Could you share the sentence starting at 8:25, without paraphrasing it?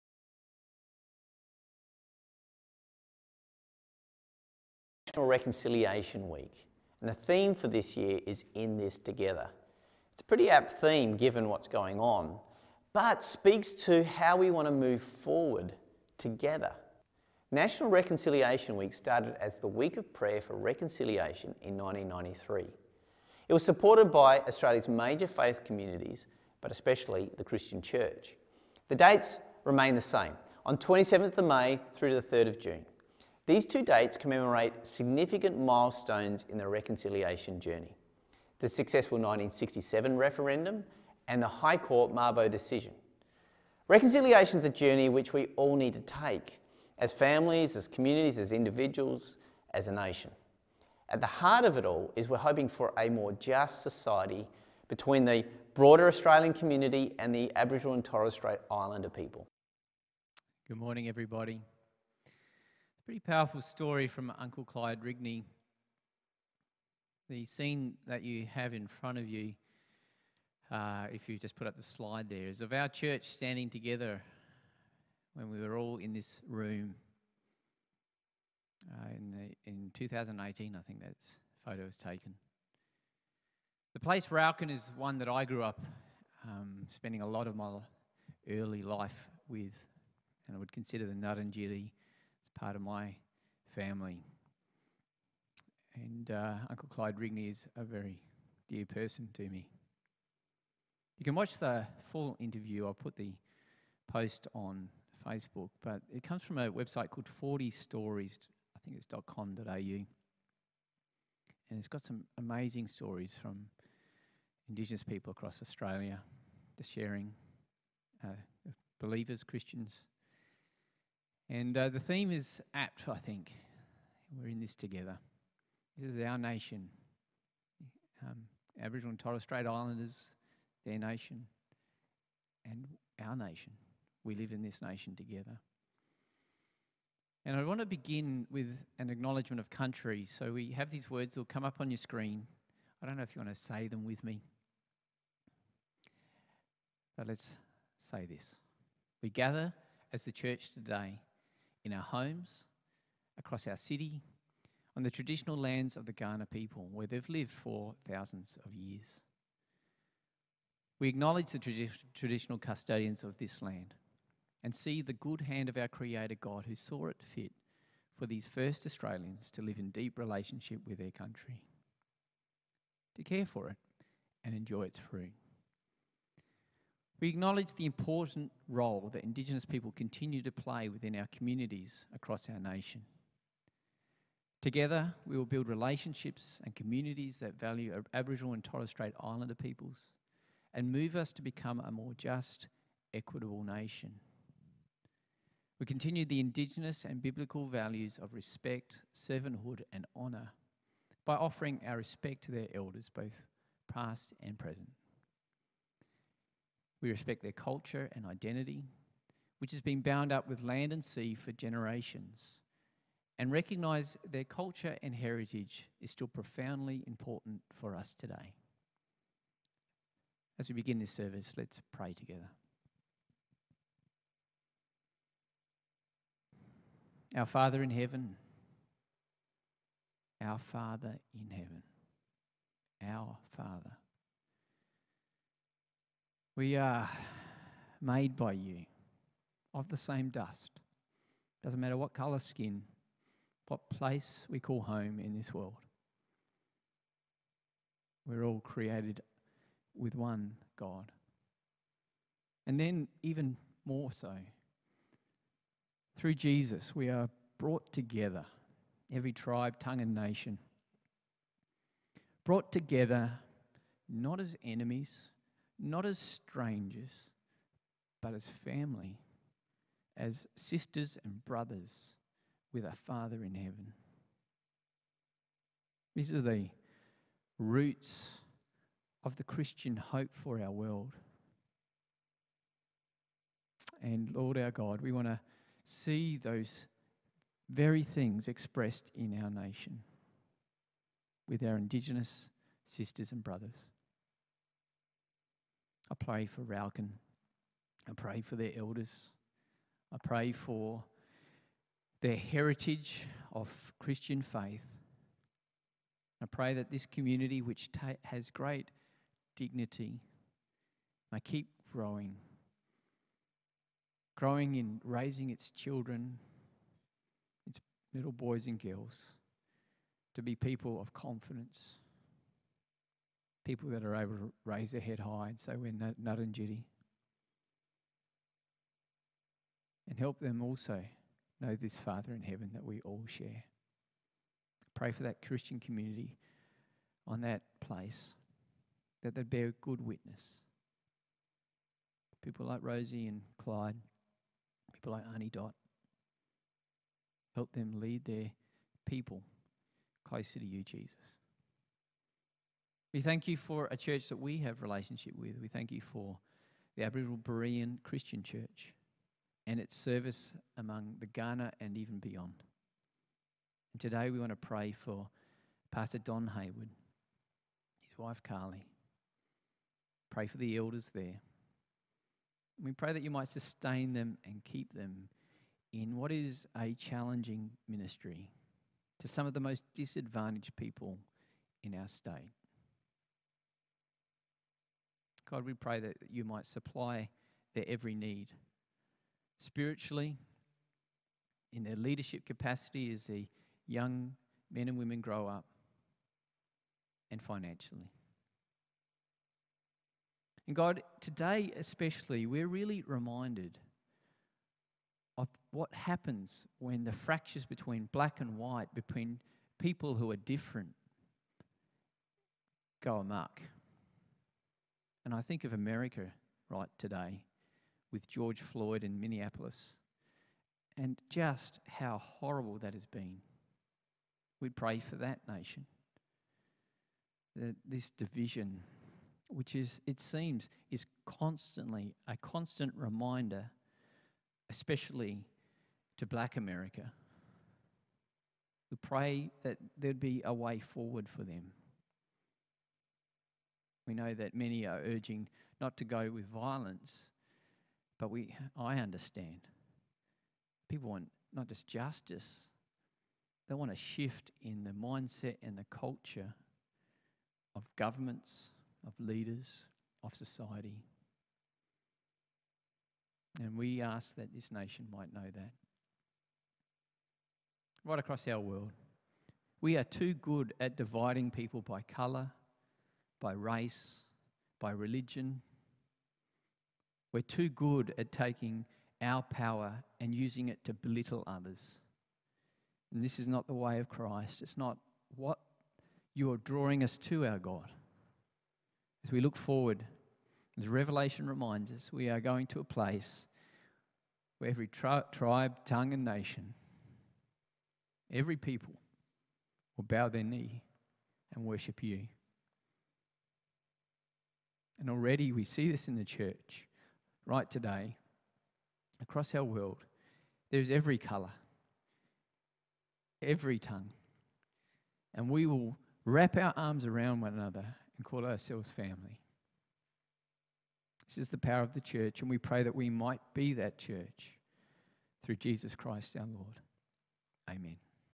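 And already we see this in the church, right today, across our world.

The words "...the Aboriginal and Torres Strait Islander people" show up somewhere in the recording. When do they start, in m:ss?
0:57.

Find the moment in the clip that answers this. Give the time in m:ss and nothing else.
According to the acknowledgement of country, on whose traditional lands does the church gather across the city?
2:36.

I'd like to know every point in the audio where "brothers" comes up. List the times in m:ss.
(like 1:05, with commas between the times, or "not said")
4:31, 4:53.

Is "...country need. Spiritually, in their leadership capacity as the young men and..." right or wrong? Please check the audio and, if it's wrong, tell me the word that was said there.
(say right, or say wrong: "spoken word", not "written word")
wrong: "every", not "country".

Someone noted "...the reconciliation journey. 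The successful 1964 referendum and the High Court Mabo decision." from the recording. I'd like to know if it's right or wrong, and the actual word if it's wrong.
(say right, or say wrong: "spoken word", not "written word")
wrong: "1967", not "1964".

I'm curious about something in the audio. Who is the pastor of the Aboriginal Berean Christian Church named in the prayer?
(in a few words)
Don Hayward.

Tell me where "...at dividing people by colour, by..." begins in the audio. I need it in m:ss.
7:50.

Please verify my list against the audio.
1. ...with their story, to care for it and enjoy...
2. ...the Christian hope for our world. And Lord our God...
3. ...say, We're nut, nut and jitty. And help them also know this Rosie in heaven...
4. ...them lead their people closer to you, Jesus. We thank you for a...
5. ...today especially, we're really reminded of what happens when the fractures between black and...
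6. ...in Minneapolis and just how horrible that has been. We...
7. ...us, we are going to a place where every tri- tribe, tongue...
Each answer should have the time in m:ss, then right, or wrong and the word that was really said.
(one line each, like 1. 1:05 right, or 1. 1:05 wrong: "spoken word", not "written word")
1. 2:50 wrong: "country", not "story"
2. 4:39 right
3. 5:25 wrong: "Father", not "Rosie"
4. 5:47 right
5. 6:41 right
6. 6:59 right
7. 8:11 right.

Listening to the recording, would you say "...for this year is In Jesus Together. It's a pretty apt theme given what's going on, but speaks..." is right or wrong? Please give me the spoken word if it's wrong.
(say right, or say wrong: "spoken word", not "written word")
wrong: "This", not "Jesus".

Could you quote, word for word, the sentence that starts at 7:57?
We're too good at taking our power and using it to belittle others.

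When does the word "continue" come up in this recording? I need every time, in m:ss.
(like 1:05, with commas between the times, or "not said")
2:59, 3:15.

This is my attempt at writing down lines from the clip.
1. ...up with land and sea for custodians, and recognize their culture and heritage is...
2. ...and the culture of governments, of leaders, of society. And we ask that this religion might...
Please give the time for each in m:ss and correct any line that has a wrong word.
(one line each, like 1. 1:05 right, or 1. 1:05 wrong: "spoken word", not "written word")
1. 3:30 wrong: "generations", not "custodians"
2. 7:35 wrong: "nation", not "religion".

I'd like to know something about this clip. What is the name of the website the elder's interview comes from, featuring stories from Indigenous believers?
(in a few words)
40 Stories.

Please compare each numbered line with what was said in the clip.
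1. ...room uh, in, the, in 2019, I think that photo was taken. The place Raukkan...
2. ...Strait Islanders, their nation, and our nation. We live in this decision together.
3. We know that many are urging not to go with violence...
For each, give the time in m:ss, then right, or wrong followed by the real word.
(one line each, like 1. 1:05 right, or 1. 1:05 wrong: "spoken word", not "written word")
1. 1:16 wrong: "2018", not "2019"
2. 2:09 wrong: "nation", not "decision"
3. 7:24 right.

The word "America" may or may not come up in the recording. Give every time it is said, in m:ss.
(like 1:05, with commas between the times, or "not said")
6:55, 7:16.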